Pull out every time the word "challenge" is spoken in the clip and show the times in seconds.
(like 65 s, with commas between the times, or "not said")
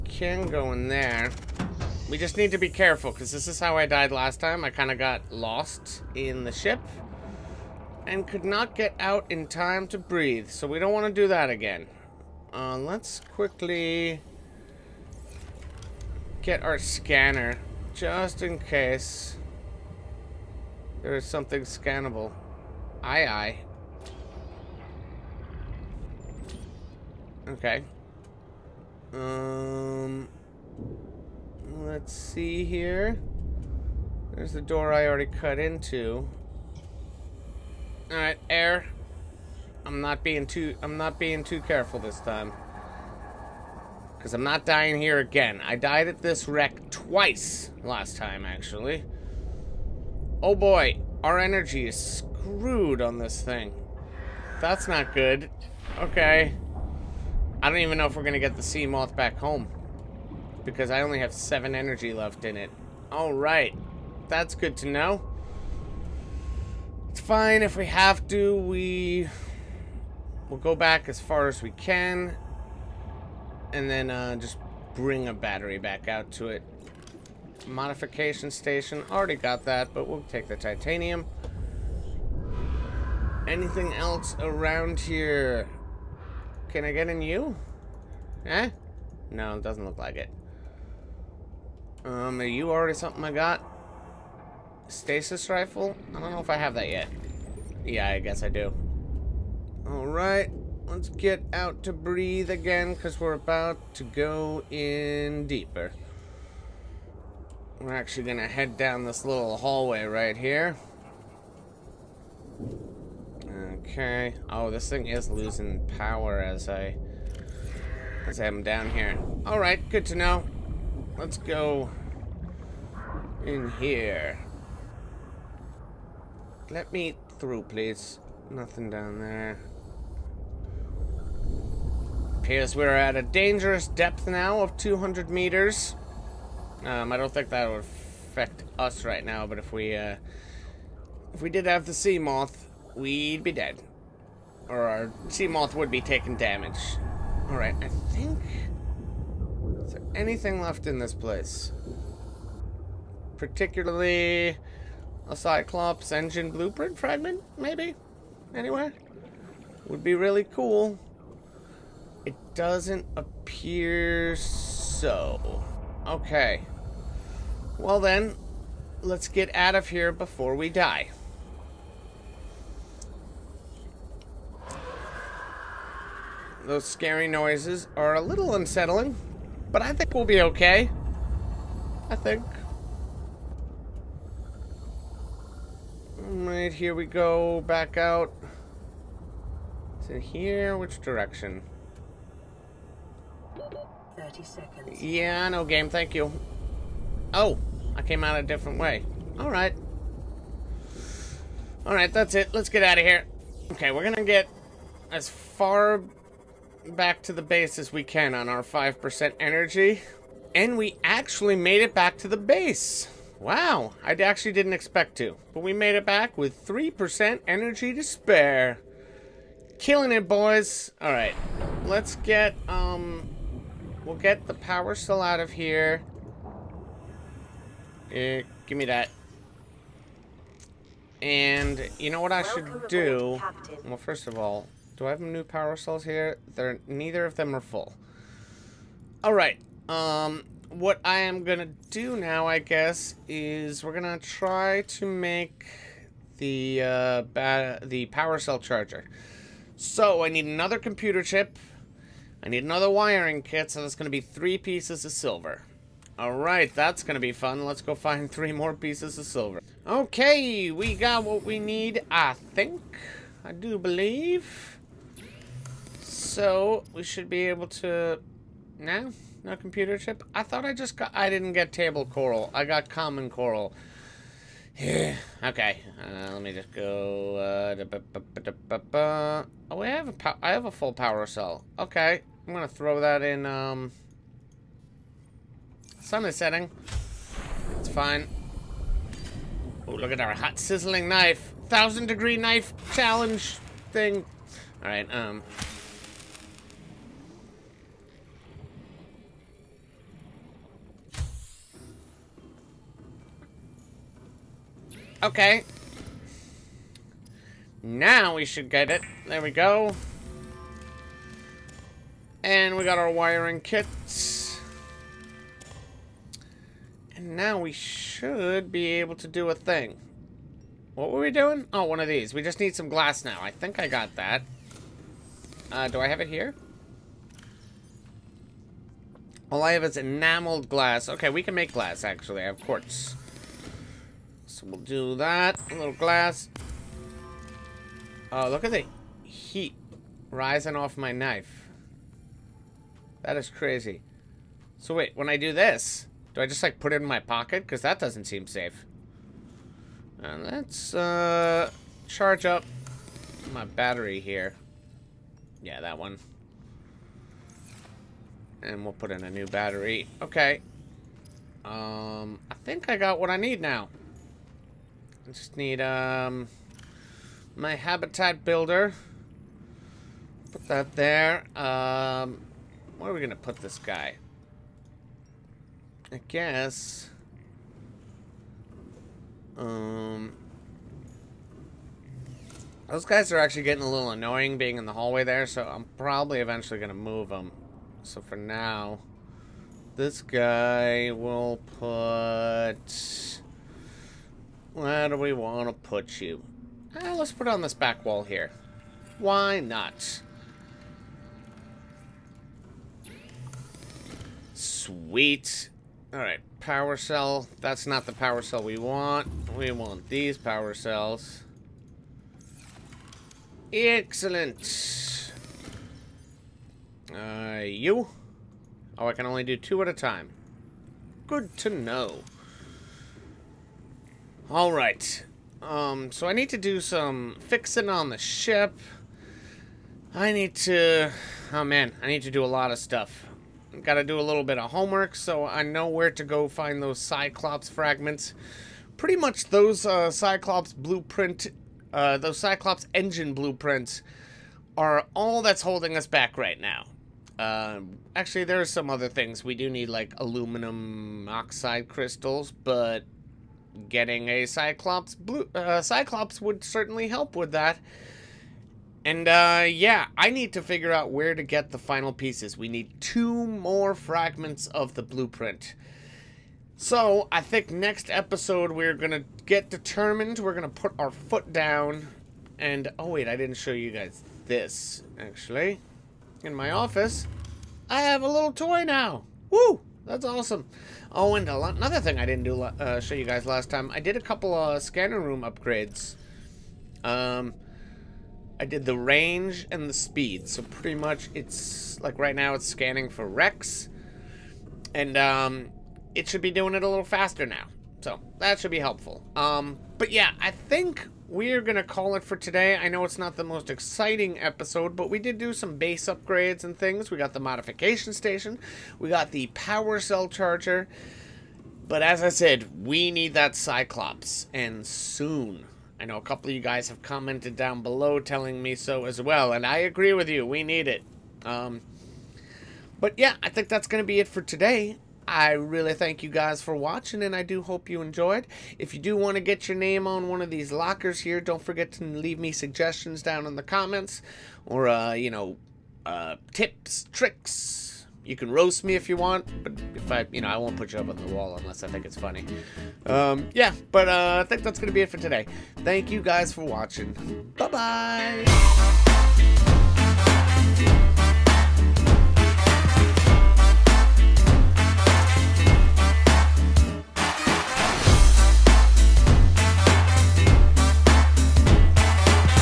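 292 s.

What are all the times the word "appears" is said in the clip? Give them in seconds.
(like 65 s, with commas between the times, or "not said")
132 s, 163 s.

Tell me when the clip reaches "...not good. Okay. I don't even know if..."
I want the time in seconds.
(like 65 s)
54 s.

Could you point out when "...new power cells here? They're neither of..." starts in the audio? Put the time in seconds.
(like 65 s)
235 s.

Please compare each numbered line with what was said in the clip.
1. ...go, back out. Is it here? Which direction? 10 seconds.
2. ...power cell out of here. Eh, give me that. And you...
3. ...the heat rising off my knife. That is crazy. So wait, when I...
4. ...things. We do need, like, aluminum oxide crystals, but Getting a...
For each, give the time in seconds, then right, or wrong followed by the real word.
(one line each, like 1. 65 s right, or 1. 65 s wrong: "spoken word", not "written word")
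1. 187 s wrong: "30", not "10"
2. 224 s right
3. 338 s right
4. 449 s right.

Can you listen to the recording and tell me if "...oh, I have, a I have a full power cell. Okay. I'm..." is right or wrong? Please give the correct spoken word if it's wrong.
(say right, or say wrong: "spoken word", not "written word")
right.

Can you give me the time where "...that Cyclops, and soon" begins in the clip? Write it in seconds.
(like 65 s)
513 s.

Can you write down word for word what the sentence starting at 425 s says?
Um, so I need to do some fixing on the ship.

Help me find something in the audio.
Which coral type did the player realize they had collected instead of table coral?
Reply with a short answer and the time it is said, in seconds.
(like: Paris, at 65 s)
Common coral, at 272 s.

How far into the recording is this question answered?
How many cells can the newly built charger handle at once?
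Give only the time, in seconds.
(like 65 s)
419 s.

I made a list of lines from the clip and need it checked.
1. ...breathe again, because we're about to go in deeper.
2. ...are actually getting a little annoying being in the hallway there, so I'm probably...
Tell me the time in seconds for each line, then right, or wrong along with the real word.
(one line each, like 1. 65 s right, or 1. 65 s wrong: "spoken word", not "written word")
1. 101 s right
2. 383 s right.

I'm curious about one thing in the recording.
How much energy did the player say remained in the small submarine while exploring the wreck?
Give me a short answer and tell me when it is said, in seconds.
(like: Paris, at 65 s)
7, at 61 s.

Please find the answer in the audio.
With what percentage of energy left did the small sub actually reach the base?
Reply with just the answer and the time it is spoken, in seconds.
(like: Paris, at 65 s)
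3%, at 216 s.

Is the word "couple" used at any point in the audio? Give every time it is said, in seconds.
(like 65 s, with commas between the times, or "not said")
484 s, 516 s.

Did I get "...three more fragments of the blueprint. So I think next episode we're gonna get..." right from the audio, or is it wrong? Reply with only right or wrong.
wrong.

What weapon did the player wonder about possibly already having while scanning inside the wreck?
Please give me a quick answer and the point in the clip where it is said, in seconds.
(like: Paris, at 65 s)
Stasis rifle, at 94 s.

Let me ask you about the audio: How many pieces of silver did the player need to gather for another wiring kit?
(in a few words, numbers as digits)
3.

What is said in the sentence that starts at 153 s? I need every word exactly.
Particularly a Cyclops engine blueprint fragment, maybe?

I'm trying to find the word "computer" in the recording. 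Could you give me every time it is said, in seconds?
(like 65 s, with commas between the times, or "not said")
250 s, 269 s.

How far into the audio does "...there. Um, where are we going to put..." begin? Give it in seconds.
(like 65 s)
370 s.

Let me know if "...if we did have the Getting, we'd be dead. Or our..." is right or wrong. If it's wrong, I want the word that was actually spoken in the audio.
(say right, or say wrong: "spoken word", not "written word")
wrong: "Seamoth", not "Getting".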